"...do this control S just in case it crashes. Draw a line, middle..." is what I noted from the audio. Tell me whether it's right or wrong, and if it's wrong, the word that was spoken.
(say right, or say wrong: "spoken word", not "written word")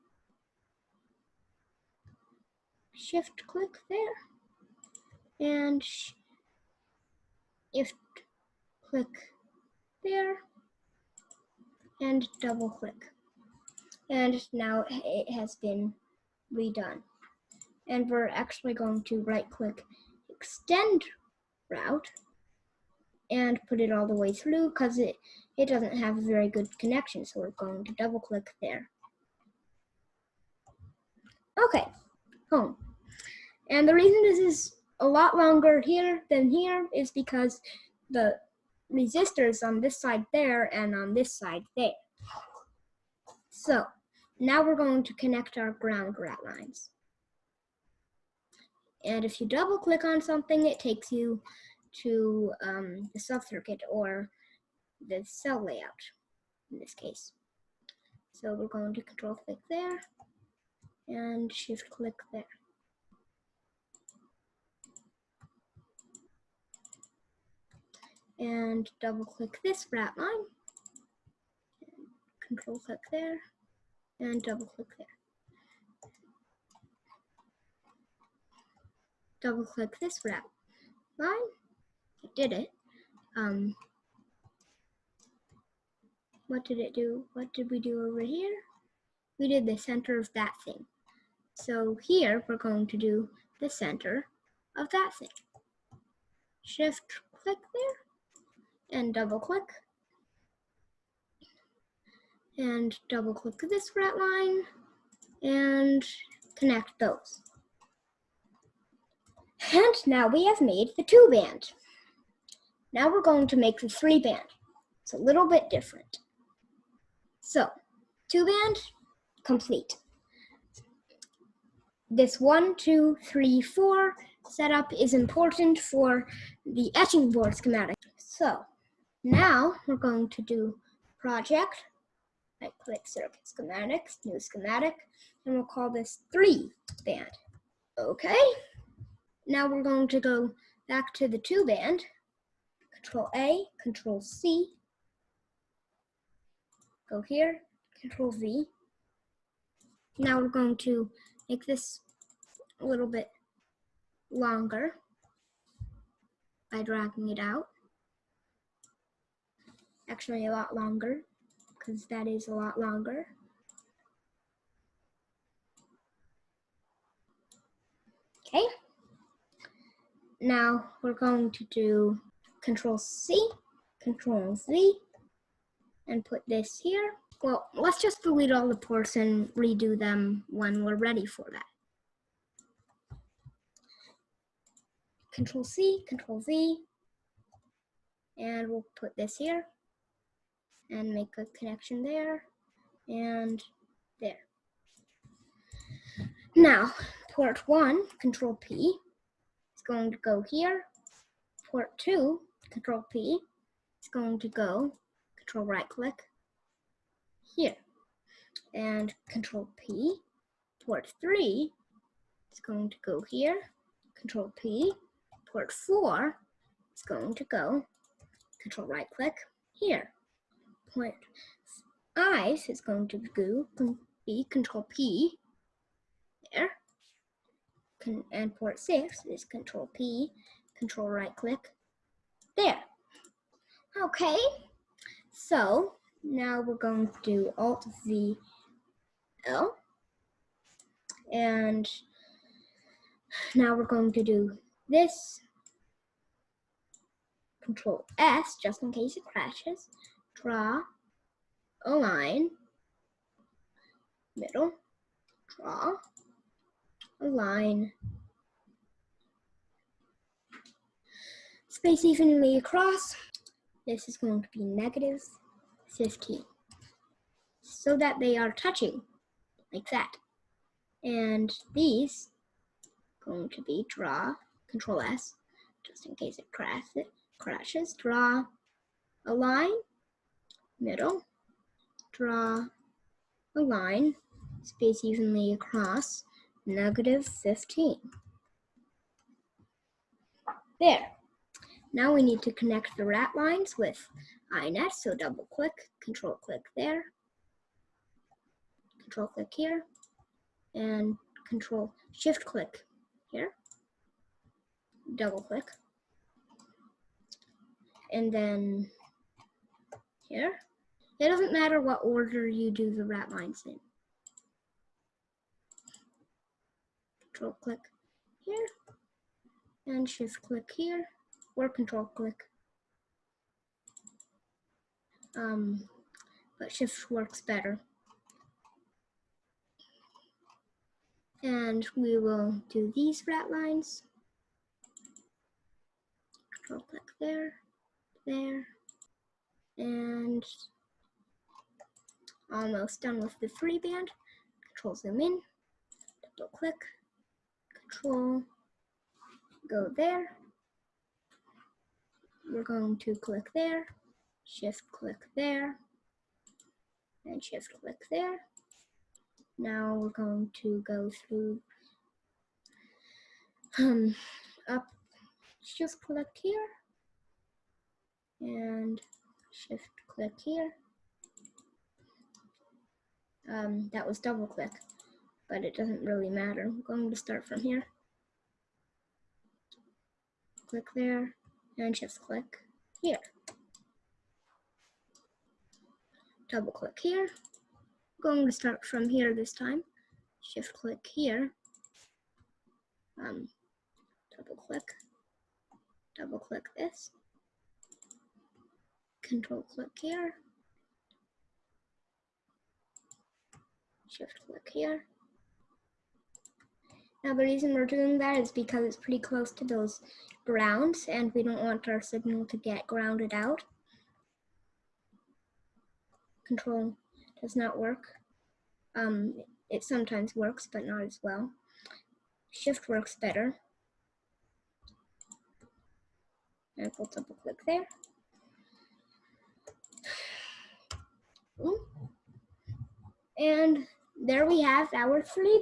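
right.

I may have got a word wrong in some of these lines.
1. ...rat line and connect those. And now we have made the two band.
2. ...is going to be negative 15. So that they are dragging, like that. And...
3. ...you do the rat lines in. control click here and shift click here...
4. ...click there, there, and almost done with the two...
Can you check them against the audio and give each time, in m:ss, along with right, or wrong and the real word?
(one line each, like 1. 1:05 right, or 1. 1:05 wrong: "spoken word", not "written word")
1. 1:43 right
2. 4:24 wrong: "touching", not "dragging"
3. 5:12 right
4. 5:36 wrong: "three", not "two".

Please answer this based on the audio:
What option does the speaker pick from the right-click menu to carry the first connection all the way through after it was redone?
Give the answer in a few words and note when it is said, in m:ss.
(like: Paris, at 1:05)
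Extend route, at 0:20.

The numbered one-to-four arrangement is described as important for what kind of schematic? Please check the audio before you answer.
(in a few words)
Etching board schematic.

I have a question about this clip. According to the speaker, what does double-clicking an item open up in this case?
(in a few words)
The cell layout.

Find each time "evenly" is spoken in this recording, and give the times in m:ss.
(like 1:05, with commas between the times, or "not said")
4:22, 4:45.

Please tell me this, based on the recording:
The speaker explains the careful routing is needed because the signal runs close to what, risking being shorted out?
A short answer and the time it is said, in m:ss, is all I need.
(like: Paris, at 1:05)
Grounds, at 6:50.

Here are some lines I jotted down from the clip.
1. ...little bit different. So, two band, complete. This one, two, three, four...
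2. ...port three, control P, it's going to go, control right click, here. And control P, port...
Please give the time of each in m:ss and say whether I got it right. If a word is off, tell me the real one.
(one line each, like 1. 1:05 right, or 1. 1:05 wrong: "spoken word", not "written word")
1. 1:55 right
2. 3:21 wrong: "two", not "three".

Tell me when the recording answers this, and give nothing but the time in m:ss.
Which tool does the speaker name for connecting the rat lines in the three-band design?
4:54.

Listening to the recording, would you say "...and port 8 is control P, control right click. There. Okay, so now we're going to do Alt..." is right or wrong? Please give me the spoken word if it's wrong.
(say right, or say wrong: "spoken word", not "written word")
wrong: "6", not "8".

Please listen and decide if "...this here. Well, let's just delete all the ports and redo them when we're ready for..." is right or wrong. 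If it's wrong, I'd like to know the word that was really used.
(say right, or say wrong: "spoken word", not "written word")
right.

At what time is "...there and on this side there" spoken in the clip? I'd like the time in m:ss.
0:40.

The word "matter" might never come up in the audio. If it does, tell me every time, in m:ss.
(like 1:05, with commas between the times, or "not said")
5:11, 6:16.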